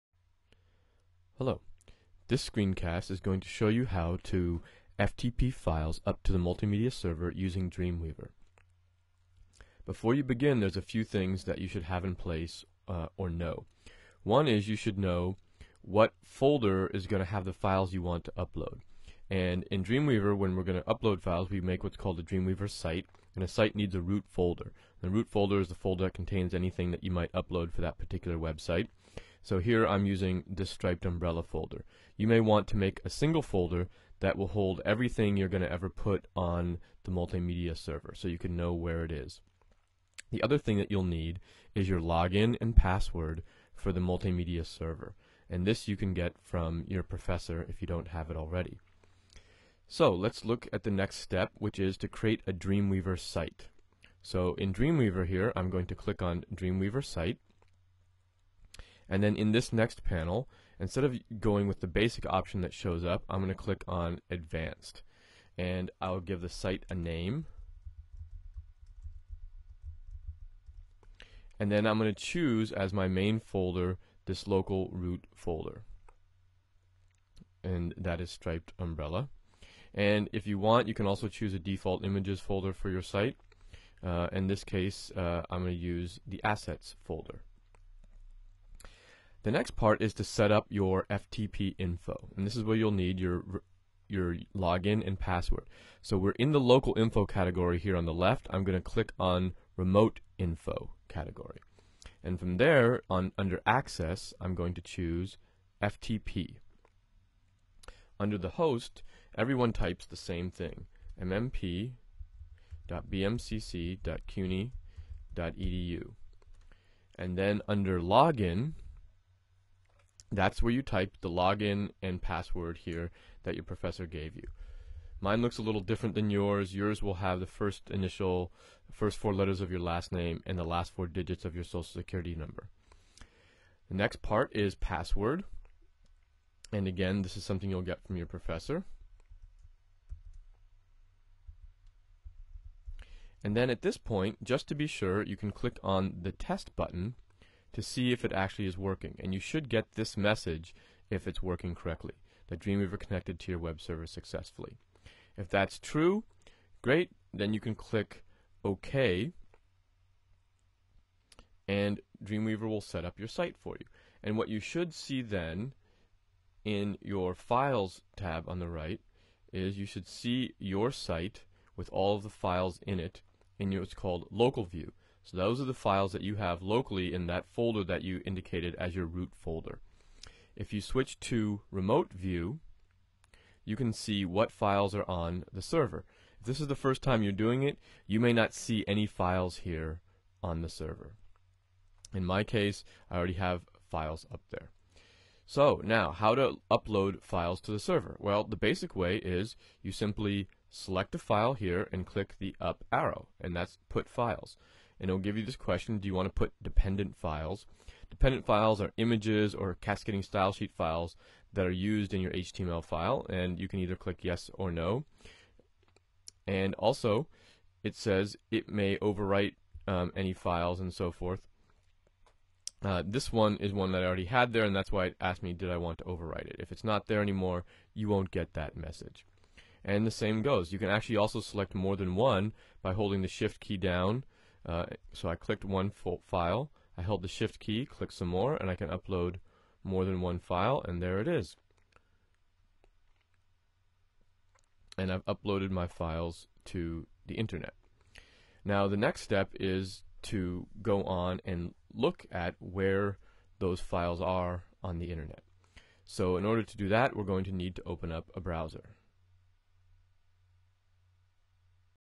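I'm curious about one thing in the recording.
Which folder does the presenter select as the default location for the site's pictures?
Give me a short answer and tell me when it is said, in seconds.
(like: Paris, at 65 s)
assets, at 86 s.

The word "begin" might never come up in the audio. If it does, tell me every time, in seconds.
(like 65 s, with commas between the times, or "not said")
10 s.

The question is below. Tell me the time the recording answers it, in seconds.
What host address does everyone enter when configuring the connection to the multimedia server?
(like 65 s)
111 s.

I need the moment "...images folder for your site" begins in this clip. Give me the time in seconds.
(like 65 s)
82 s.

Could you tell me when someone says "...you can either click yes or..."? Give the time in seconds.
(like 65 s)
213 s.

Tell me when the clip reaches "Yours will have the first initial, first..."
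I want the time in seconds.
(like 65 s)
126 s.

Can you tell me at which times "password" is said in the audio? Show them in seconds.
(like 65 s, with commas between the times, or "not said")
42 s, 95 s, 122 s, 134 s.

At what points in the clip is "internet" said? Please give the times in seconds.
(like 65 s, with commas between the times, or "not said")
247 s, 255 s.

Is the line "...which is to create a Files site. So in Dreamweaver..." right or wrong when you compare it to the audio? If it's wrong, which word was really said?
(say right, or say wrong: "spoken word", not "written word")
wrong: "Dreamweaver", not "Files".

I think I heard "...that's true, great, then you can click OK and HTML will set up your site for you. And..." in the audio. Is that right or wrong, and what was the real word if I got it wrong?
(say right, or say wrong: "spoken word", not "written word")
wrong: "Dreamweaver", not "HTML".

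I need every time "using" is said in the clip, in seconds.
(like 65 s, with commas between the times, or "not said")
7 s, 30 s.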